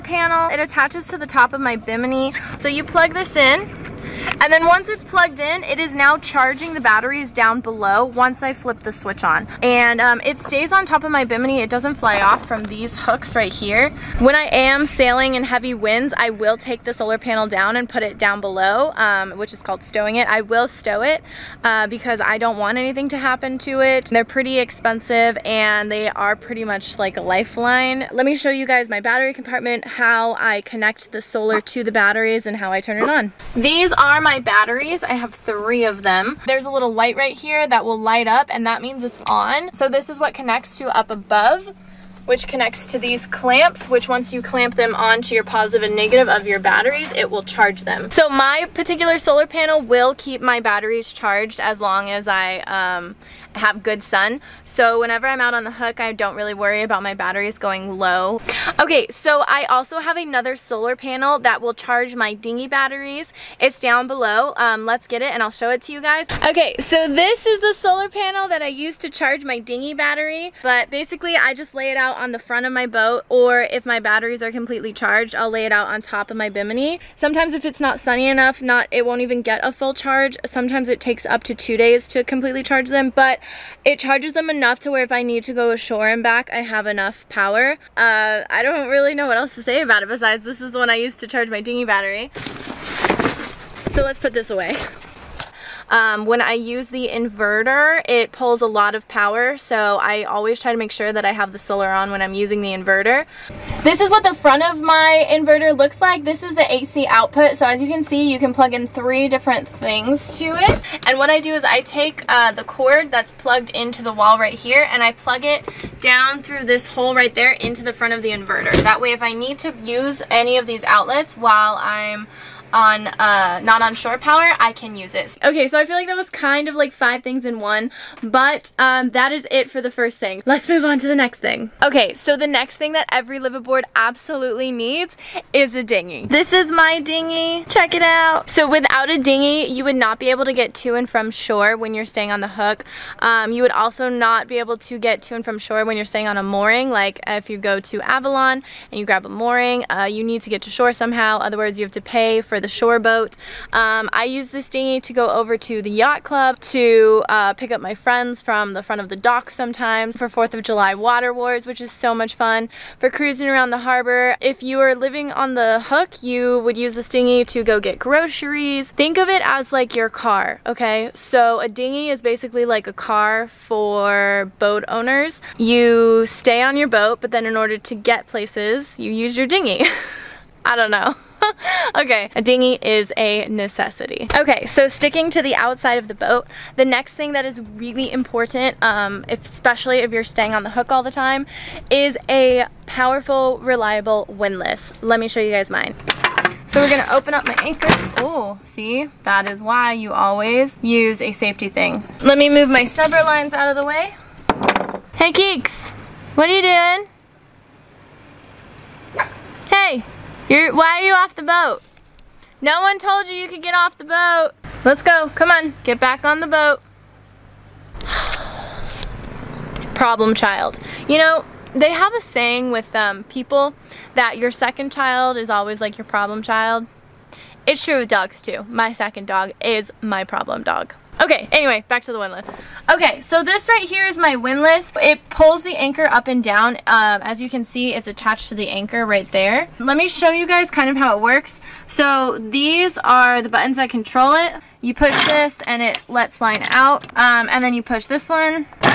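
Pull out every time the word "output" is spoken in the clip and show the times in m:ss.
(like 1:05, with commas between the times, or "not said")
1:47.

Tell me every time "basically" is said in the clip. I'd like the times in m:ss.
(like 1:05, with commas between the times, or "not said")
1:10, 2:52.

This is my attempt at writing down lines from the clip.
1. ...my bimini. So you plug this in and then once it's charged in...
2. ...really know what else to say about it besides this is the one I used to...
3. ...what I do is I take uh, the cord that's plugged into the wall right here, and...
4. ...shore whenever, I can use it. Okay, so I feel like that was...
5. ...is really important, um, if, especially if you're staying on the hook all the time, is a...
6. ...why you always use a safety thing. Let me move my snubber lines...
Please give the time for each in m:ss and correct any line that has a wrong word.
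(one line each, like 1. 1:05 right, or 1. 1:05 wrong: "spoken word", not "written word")
1. 0:01 wrong: "plugged", not "charged"
2. 1:28 right
3. 1:51 right
4. 2:03 wrong: "power", not "whenever"
5. 3:07 right
6. 3:19 right.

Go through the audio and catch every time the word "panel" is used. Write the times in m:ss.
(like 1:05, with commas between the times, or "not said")
0:17, 0:49, 1:00, 1:08.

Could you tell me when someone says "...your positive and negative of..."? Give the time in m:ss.
0:45.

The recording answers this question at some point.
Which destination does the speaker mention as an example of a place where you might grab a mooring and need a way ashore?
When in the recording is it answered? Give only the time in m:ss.
2:28.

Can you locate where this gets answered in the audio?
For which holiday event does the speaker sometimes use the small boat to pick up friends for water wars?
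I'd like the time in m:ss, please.
2:40.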